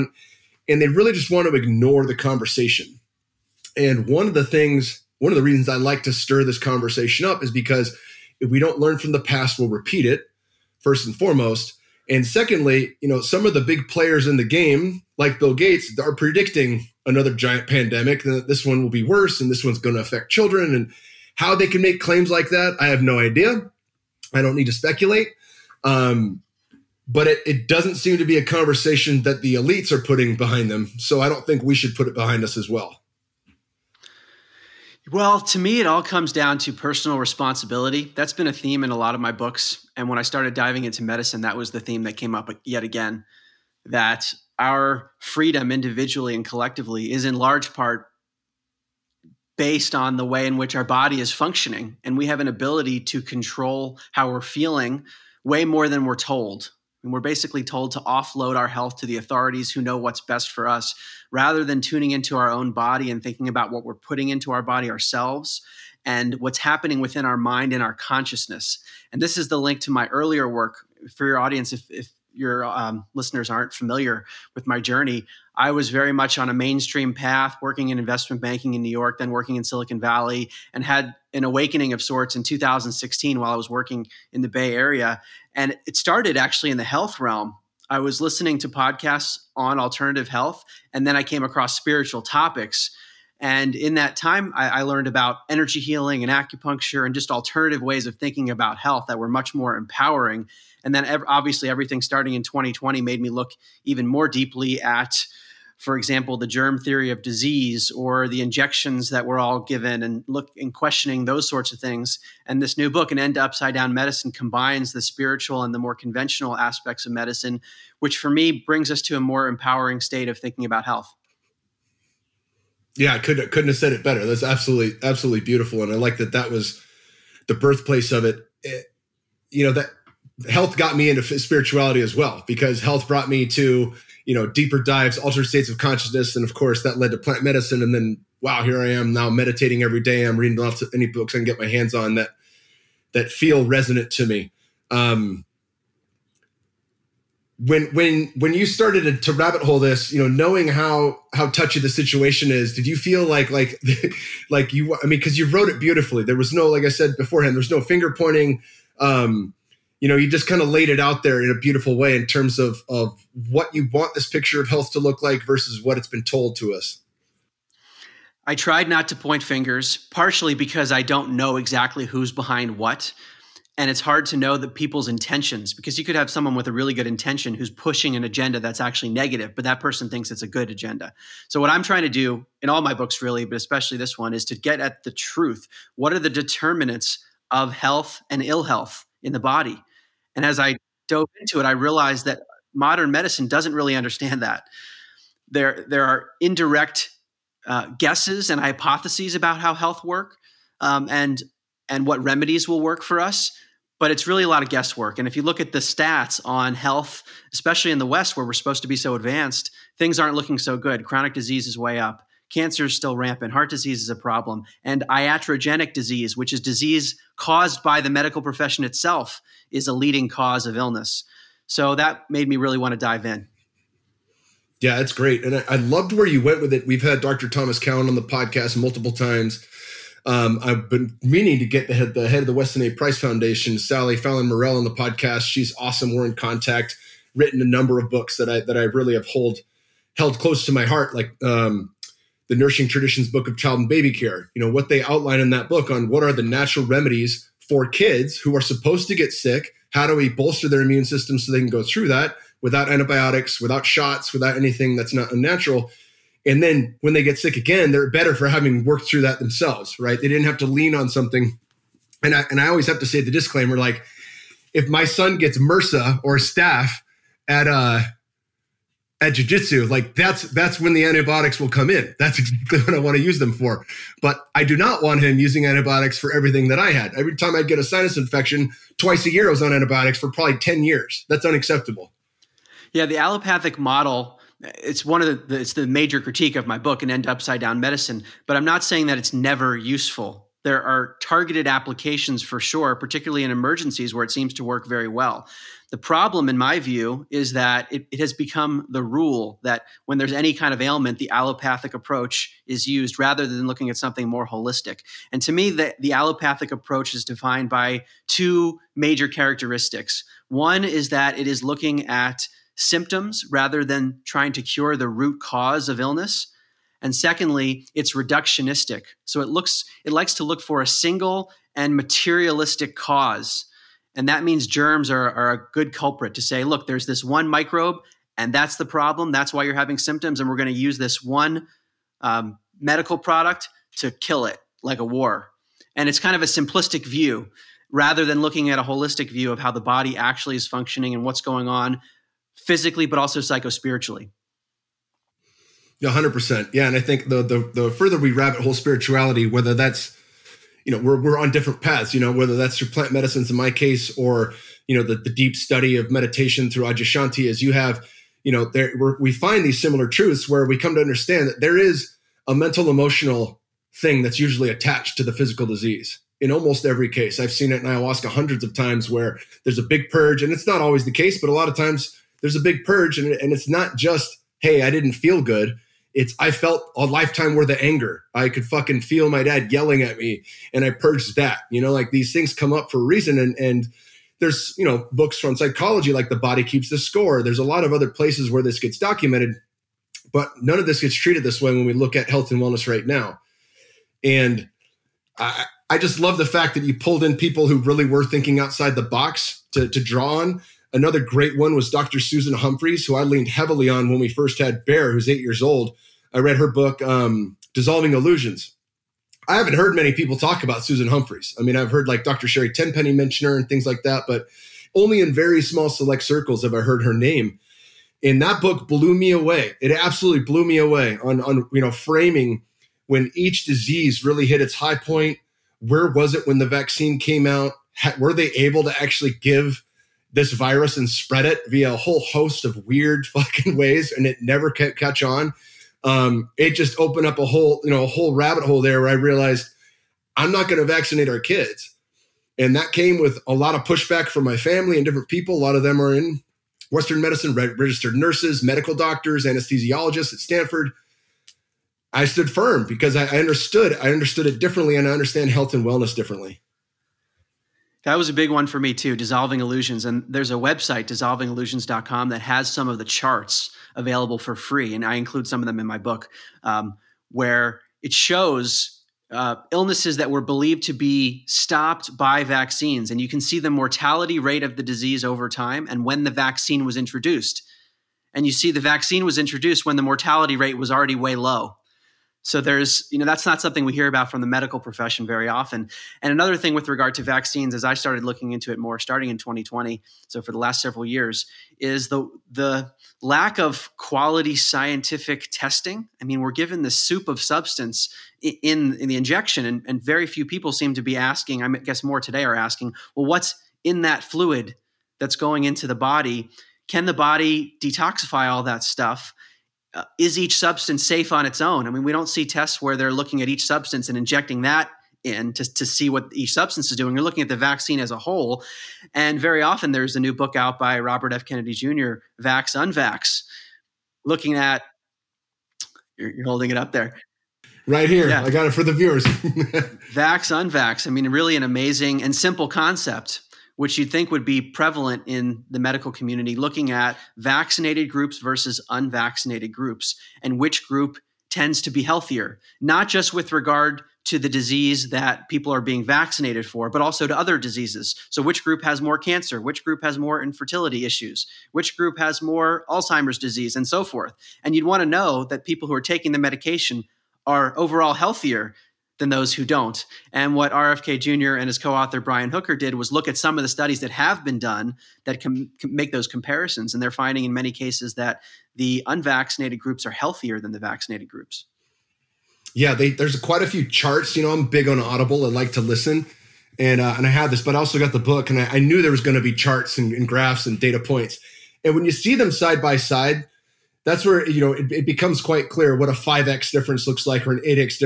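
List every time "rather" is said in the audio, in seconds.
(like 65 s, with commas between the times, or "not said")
61 s, 303 s, 313 s, 337 s.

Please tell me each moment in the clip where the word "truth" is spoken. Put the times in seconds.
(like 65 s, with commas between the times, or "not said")
185 s, 360 s.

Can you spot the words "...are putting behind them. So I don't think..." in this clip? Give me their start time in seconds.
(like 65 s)
29 s.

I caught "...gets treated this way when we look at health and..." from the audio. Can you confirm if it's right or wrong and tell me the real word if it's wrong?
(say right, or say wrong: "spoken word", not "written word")
right.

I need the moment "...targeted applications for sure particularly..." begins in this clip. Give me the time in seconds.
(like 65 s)
291 s.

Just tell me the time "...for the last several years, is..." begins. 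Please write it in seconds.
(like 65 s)
490 s.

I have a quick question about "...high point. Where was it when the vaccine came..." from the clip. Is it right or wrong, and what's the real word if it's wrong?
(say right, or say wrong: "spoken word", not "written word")
right.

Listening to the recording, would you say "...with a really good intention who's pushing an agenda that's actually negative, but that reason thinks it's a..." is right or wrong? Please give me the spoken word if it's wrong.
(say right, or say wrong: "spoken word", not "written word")
wrong: "person", not "reason".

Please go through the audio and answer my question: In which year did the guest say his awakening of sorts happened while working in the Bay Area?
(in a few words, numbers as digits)
2016.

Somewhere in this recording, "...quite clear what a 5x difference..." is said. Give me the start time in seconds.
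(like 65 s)
585 s.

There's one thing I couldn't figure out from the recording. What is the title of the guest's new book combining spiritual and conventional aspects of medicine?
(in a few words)
An End to Upside Down Medicine.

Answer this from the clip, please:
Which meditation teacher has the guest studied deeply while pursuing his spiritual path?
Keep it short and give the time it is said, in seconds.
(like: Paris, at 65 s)
Adyashanti, at 356 s.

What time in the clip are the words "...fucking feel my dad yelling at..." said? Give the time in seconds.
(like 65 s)
378 s.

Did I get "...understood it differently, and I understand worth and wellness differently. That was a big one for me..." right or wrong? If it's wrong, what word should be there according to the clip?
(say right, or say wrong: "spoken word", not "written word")
wrong: "health", not "worth".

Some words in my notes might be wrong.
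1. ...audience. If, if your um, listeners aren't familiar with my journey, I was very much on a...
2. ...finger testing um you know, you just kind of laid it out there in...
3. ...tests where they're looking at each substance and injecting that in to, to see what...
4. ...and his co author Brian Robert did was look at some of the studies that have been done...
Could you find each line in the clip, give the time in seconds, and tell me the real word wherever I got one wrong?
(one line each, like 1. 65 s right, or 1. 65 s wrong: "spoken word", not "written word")
1. 71 s right
2. 157 s wrong: "pointing", not "testing"
3. 512 s right
4. 561 s wrong: "Hooker", not "Robert".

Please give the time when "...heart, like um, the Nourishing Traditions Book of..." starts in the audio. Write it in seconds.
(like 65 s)
240 s.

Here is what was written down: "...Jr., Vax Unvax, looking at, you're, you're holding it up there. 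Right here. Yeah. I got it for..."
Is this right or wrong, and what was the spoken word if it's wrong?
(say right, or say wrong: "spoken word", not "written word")
right.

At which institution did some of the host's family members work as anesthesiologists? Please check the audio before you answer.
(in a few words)
Stanford.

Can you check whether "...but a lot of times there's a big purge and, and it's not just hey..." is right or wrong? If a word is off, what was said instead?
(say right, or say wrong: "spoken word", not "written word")
right.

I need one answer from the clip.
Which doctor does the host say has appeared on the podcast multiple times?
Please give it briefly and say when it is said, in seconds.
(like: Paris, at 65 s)
Thomas Cowan, at 227 s.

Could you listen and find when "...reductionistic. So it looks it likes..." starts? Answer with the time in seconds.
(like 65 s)
318 s.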